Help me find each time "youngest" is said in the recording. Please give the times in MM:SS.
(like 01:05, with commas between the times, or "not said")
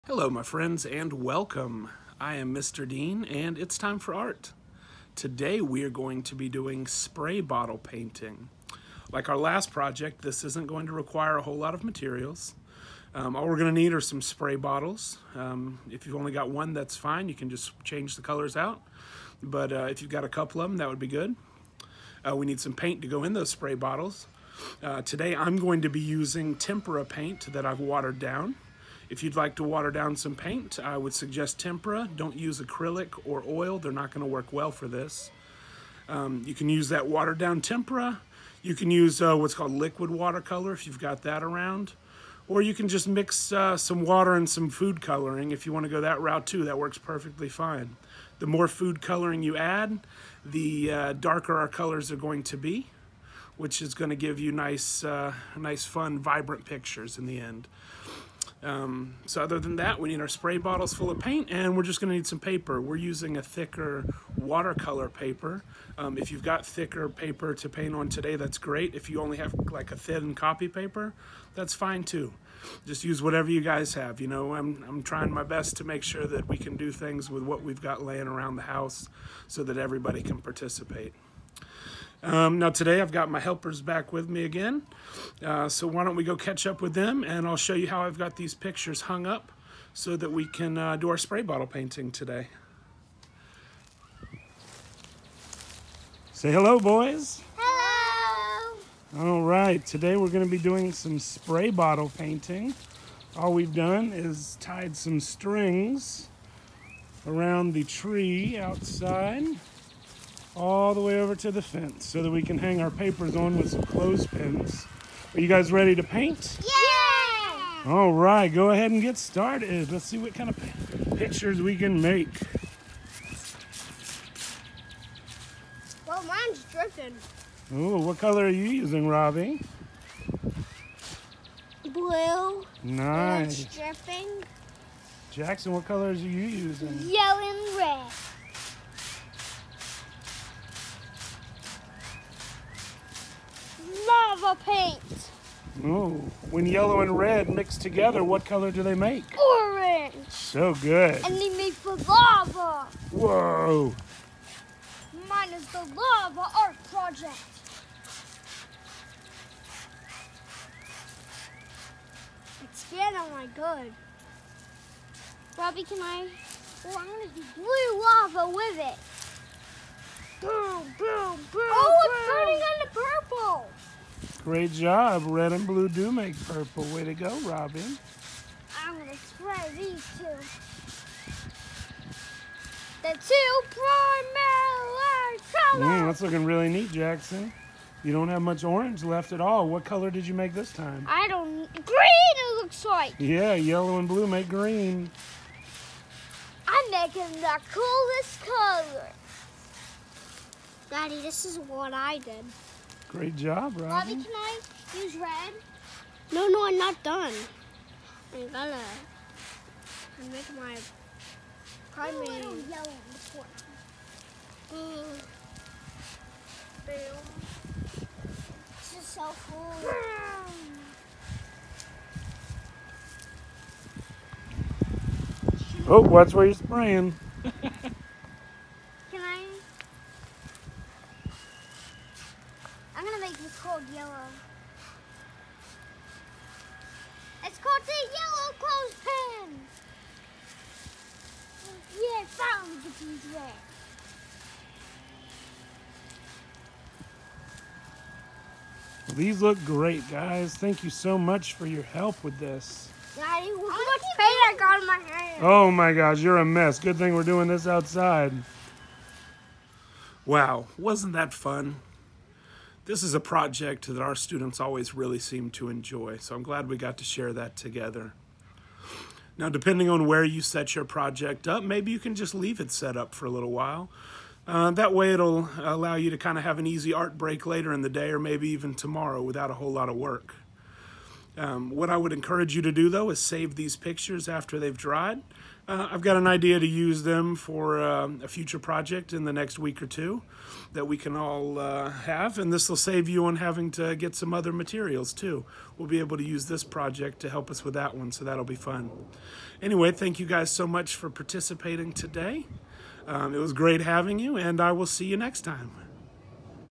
not said.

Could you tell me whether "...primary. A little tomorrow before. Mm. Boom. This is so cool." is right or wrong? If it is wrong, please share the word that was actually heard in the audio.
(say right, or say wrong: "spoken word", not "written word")
wrong: "yellow", not "tomorrow".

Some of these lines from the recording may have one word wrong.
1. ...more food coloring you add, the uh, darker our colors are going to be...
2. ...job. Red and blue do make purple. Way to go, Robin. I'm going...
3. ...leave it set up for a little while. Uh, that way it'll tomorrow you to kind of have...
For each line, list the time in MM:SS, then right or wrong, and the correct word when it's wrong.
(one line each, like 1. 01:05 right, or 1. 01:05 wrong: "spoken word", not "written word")
1. 00:48 right
2. 02:54 right
3. 04:32 wrong: "allow", not "tomorrow".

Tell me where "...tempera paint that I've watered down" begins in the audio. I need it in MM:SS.
00:26.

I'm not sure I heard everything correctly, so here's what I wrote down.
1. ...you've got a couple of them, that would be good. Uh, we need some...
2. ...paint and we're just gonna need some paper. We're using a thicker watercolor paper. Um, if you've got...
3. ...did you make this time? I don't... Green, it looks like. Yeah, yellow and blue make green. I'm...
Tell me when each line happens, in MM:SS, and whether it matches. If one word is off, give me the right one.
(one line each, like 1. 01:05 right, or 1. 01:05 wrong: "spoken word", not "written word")
1. 00:20 right
2. 01:01 right
3. 03:10 right.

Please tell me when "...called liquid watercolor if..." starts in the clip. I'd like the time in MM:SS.
00:39.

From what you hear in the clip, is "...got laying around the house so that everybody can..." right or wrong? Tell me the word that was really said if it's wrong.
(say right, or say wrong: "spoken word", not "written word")
right.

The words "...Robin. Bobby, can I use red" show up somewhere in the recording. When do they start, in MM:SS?
03:23.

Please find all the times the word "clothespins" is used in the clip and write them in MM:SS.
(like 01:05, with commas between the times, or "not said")
01:53, 03:59.